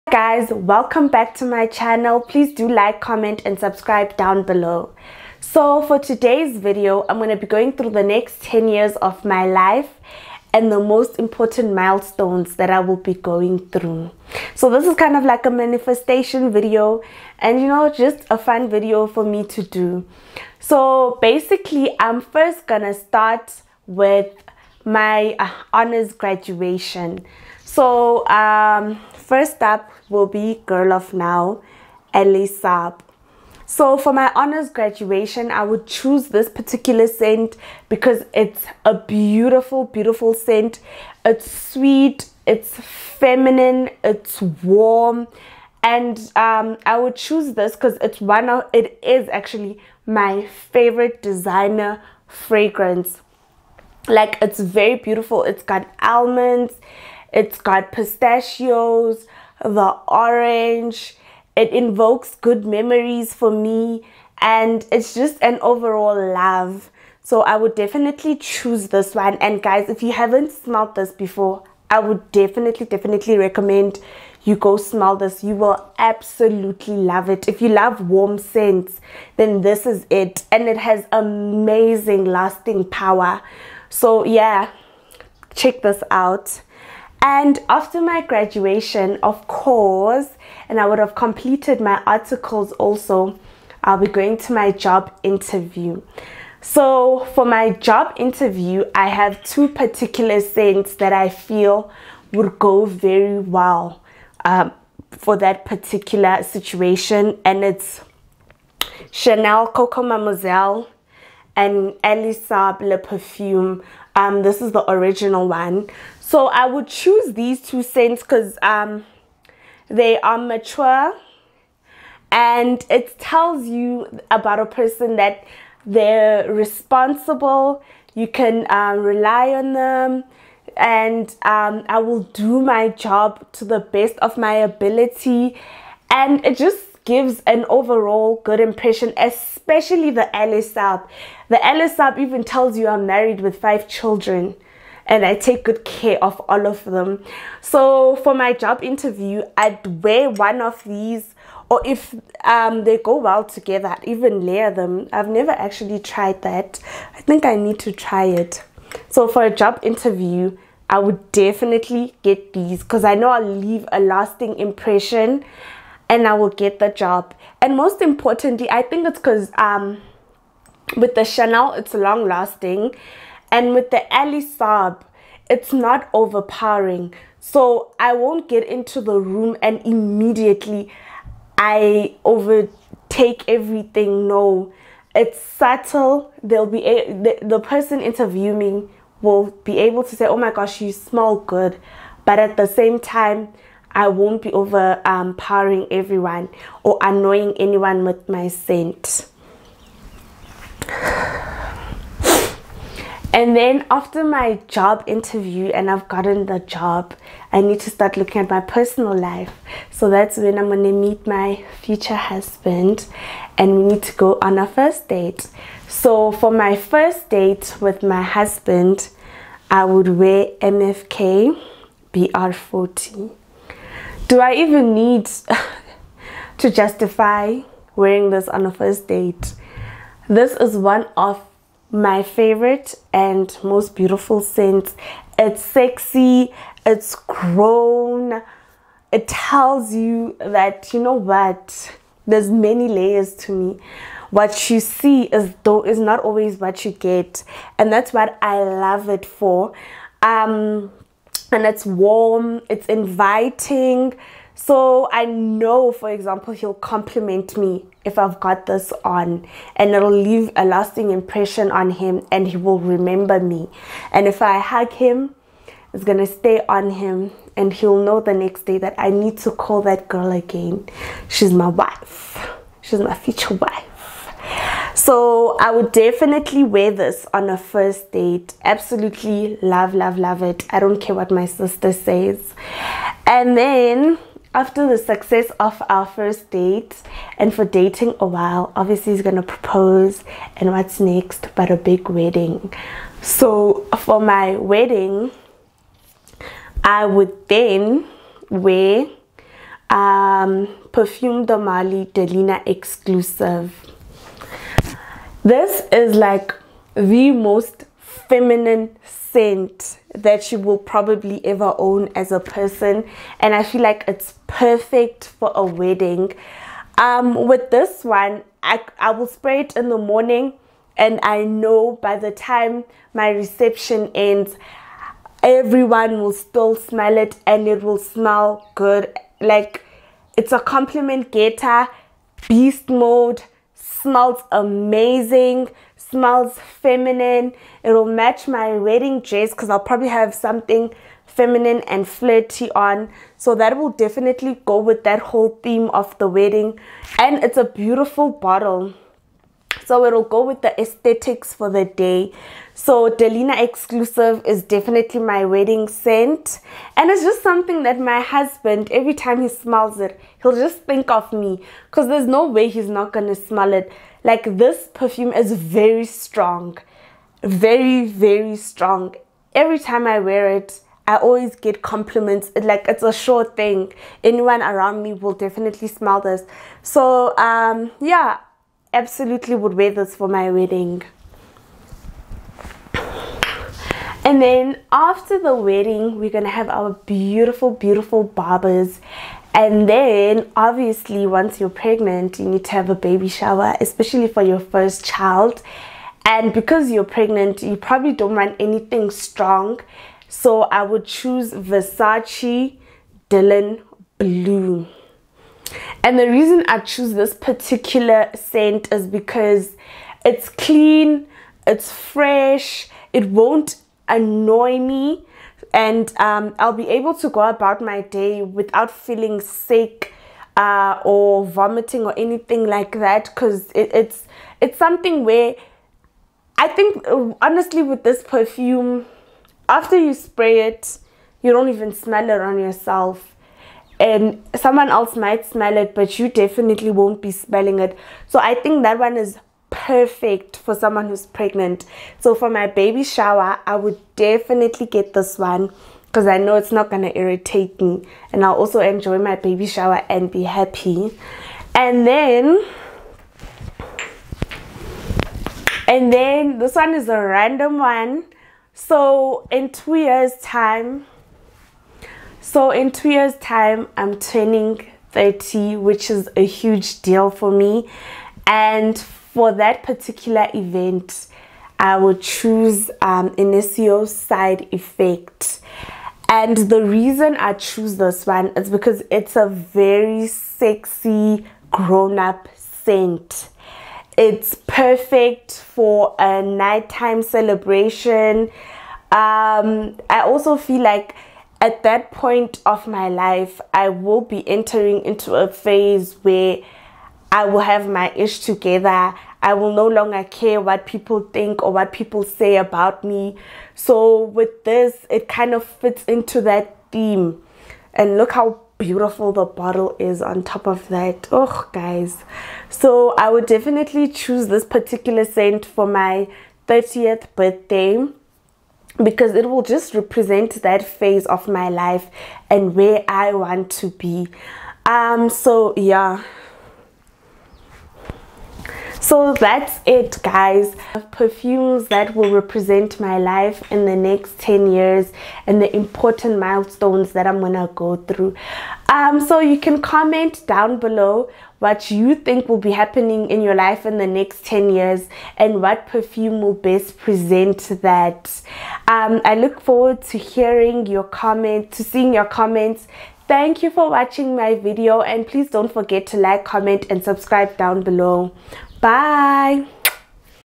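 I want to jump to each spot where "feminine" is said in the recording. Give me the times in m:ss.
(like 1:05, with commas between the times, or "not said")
0:42, 5:08, 5:36, 5:41.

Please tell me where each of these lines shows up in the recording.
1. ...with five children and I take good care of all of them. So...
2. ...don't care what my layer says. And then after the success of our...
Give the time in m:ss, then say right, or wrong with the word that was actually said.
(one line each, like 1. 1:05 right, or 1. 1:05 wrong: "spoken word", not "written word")
1. 2:23 right
2. 4:40 wrong: "sister", not "layer".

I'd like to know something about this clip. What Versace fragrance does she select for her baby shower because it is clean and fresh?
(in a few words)
Dylan Blue.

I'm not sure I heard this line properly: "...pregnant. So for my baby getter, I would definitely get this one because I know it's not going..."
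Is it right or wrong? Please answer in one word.
wrong.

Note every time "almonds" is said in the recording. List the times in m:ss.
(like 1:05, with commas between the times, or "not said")
0:56.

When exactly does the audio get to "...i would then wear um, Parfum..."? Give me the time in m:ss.
4:56.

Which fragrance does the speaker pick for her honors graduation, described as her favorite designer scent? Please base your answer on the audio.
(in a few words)
Girl of Now.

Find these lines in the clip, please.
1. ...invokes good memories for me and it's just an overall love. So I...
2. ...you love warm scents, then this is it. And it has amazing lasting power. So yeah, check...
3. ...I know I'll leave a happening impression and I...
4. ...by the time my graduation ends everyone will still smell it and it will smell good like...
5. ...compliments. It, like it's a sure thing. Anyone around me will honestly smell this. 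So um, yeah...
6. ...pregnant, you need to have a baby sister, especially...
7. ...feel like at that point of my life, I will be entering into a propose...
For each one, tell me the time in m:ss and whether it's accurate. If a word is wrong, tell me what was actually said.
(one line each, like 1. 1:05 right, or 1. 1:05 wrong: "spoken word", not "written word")
1. 1:01 right
2. 1:17 right
3. 2:43 wrong: "lasting", not "happening"
4. 5:22 wrong: "reception", not "graduation"
5. 6:11 wrong: "definitely", not "honestly"
6. 6:31 wrong: "shower", not "sister"
7. 8:10 wrong: "phase", not "propose".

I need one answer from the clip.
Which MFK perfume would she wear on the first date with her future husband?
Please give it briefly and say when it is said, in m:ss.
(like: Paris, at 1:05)
BR540, at 3:40.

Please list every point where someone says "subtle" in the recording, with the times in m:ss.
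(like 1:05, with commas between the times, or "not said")
3:05.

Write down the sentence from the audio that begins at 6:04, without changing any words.
Like this perfume is very strong, very, very strong.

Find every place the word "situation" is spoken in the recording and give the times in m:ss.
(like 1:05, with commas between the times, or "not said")
1:46.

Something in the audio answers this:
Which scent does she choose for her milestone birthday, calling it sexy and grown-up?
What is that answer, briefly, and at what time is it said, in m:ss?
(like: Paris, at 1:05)
Side Effect, at 7:54.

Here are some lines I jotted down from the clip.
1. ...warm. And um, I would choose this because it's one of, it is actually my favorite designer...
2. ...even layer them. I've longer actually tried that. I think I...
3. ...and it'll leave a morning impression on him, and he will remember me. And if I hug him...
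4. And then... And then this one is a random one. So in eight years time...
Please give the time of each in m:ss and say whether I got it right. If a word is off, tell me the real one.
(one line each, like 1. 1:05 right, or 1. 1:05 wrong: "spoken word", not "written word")
1. 0:44 right
2. 2:34 wrong: "never", not "longer"
3. 4:19 wrong: "lasting", not "morning"
4. 7:31 wrong: "two", not "eight".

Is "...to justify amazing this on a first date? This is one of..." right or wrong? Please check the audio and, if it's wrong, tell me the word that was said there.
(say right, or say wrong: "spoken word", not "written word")
wrong: "wearing", not "amazing".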